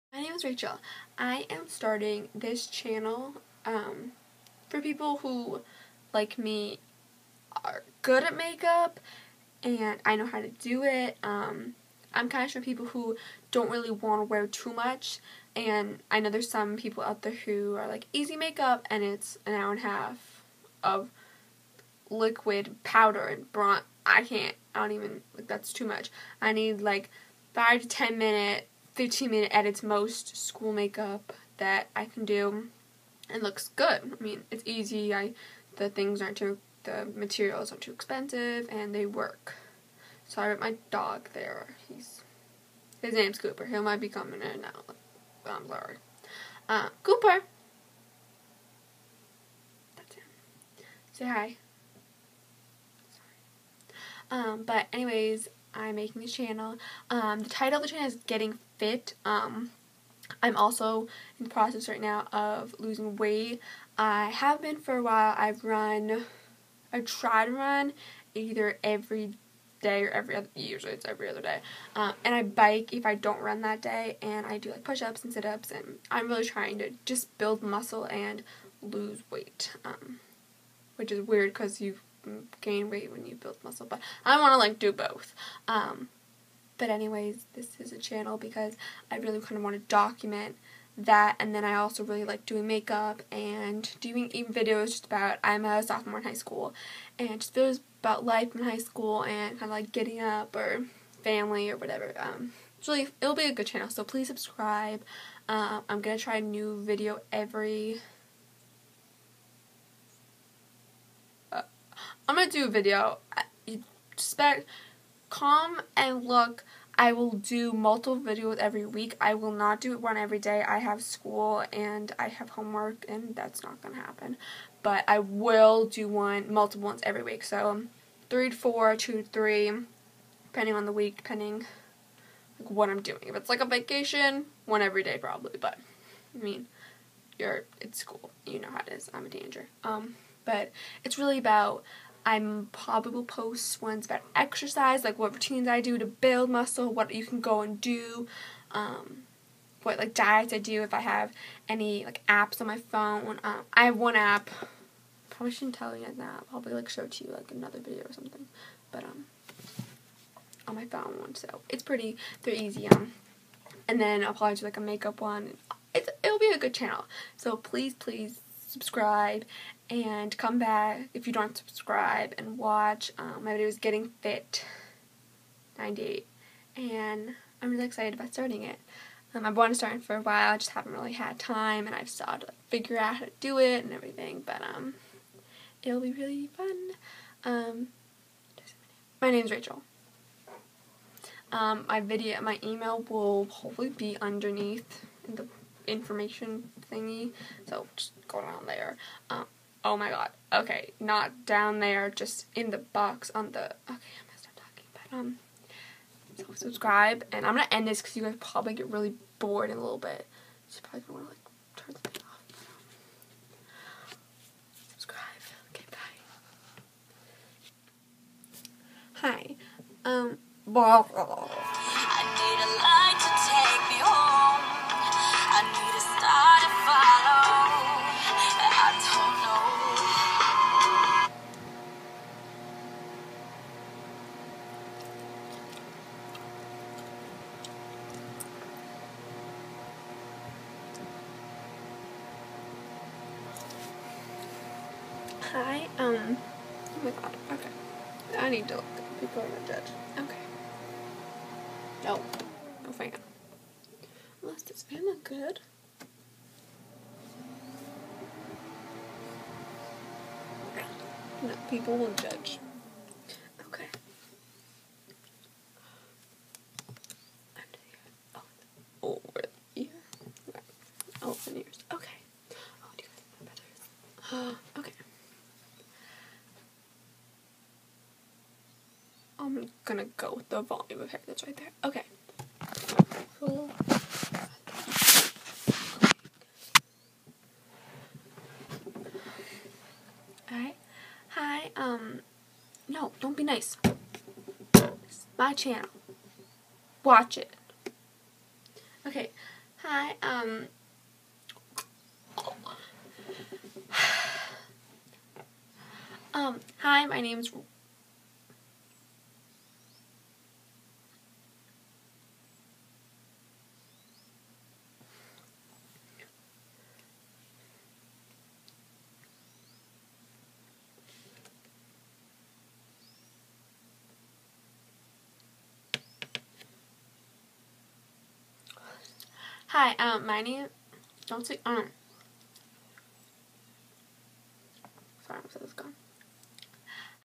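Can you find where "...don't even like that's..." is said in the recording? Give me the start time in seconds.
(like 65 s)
24 s.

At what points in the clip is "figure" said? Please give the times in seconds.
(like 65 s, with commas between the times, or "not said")
182 s.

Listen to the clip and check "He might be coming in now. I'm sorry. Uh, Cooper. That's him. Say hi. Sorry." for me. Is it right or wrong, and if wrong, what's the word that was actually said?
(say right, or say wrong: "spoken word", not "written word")
right.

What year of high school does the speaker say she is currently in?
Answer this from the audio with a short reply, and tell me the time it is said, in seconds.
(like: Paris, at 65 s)
sophomore, at 95 s.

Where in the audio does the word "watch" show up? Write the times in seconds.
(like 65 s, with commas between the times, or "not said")
172 s, 297 s.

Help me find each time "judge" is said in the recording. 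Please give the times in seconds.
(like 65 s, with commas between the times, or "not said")
249 s, 262 s.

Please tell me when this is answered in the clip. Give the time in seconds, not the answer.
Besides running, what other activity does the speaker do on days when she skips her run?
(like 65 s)
72 s.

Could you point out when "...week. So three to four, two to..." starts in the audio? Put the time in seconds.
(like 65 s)
127 s.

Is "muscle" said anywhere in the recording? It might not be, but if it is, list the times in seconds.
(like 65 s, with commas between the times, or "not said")
77 s, 83 s, 146 s.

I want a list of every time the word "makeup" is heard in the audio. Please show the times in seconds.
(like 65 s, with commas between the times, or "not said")
8 s, 18 s, 30 s, 92 s, 164 s.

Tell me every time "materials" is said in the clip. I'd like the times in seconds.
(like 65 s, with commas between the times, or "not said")
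37 s.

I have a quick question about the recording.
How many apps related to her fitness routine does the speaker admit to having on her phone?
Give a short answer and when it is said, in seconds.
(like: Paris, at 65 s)
1, at 153 s.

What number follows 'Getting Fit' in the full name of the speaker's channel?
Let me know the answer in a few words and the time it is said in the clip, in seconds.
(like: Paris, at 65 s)
98, at 175 s.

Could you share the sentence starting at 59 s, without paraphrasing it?
Um, I'm also in the process right now of losing weight.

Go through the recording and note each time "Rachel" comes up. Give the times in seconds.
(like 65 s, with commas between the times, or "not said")
0 s, 189 s.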